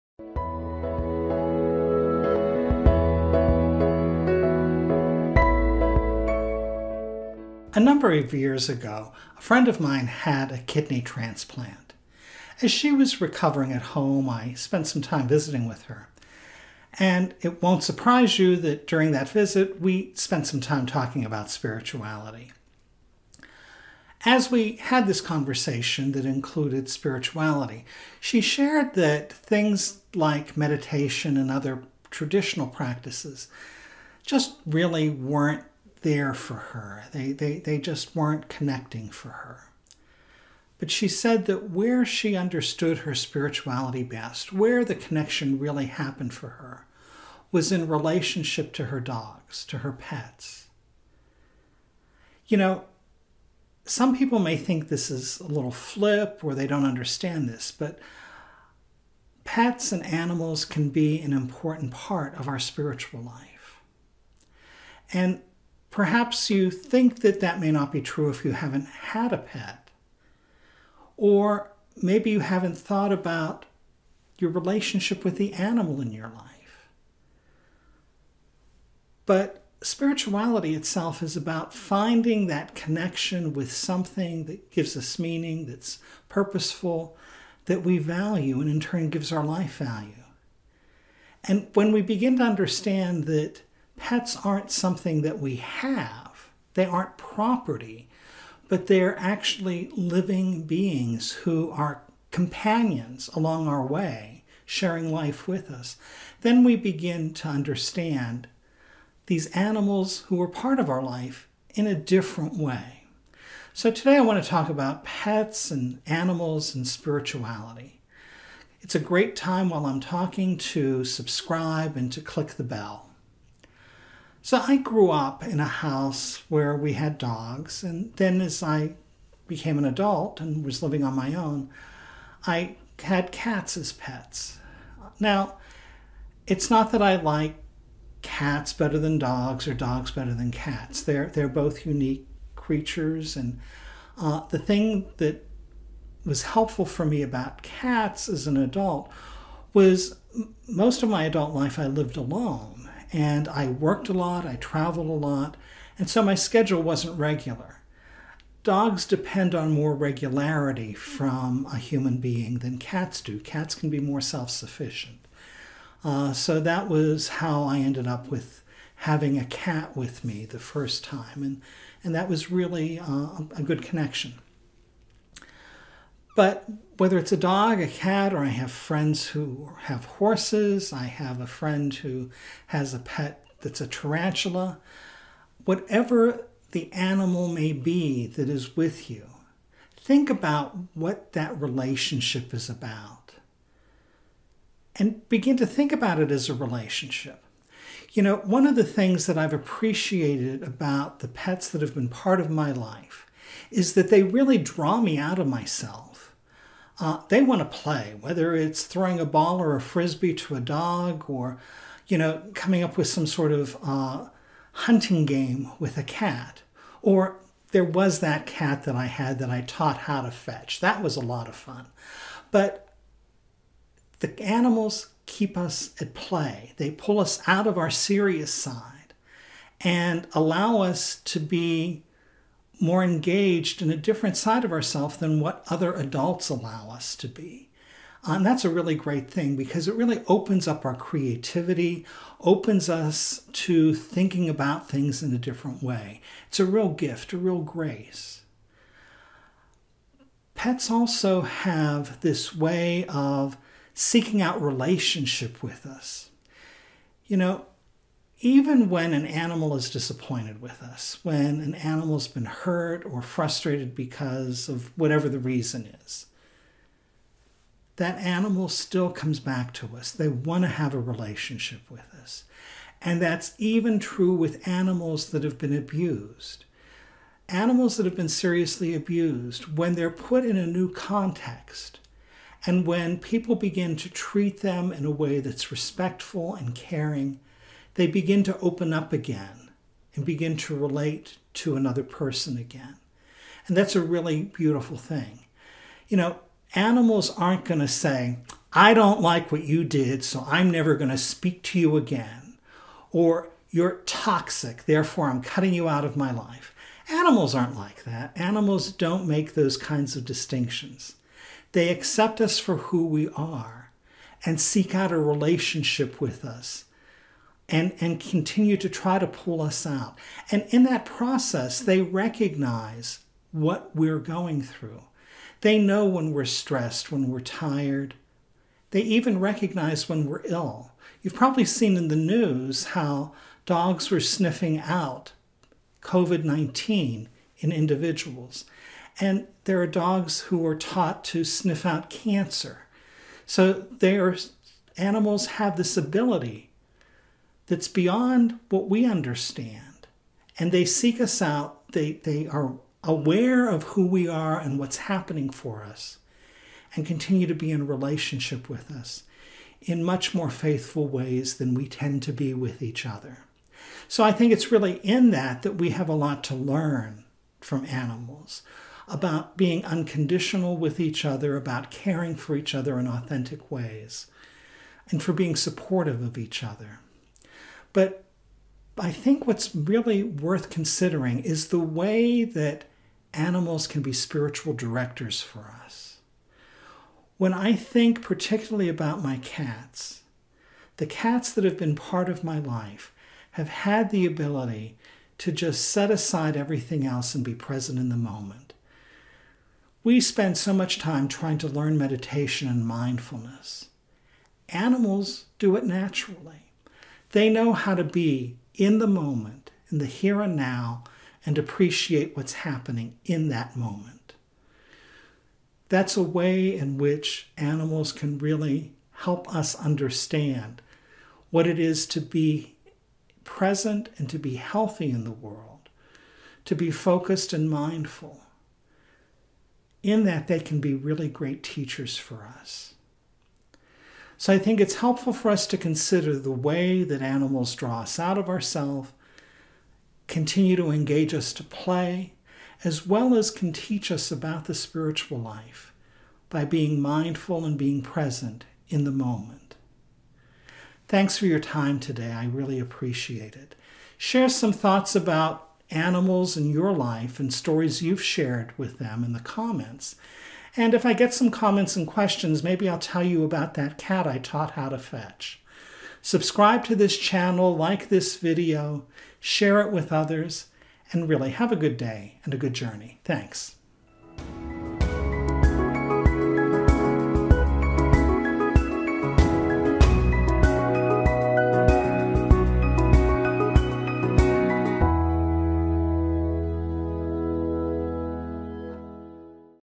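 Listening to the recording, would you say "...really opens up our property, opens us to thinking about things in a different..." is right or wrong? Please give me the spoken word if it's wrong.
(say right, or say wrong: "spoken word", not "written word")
wrong: "creativity", not "property".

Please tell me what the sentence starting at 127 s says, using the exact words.
And then as I became an adult and was living on my own, I had cats as pets.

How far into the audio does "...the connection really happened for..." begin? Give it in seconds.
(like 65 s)
44 s.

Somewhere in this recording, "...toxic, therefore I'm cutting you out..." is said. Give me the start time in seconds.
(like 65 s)
304 s.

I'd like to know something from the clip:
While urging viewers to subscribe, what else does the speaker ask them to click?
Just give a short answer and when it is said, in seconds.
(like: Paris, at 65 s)
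the bell, at 122 s.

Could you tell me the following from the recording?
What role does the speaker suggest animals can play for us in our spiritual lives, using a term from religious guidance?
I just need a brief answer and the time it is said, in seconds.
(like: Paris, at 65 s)
spiritual directors, at 384 s.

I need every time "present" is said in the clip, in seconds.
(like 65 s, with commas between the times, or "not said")
397 s, 423 s, 448 s.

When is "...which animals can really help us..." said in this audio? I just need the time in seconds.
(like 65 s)
416 s.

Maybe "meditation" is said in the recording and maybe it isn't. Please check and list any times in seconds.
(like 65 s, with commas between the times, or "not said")
30 s, 401 s.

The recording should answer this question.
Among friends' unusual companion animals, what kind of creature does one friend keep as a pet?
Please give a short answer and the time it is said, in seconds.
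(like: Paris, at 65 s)
tarantula, at 183 s.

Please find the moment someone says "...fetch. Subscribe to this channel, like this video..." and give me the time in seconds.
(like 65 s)
464 s.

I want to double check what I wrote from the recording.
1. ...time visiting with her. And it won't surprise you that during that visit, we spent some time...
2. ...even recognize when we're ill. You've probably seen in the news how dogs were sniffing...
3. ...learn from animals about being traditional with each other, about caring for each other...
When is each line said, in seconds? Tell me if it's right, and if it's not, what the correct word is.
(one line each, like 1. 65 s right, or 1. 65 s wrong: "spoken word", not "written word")
1. 15 s right
2. 329 s right
3. 366 s wrong: "unconditional", not "traditional".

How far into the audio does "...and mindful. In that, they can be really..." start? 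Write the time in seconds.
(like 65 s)
427 s.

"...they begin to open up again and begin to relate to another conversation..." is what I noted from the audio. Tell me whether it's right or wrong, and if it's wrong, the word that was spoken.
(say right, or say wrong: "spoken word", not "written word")
wrong: "person", not "conversation".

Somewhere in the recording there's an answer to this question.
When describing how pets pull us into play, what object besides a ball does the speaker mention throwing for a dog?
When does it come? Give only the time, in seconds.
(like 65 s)
209 s.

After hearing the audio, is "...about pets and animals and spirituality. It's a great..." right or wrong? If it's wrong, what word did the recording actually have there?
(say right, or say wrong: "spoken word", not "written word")
right.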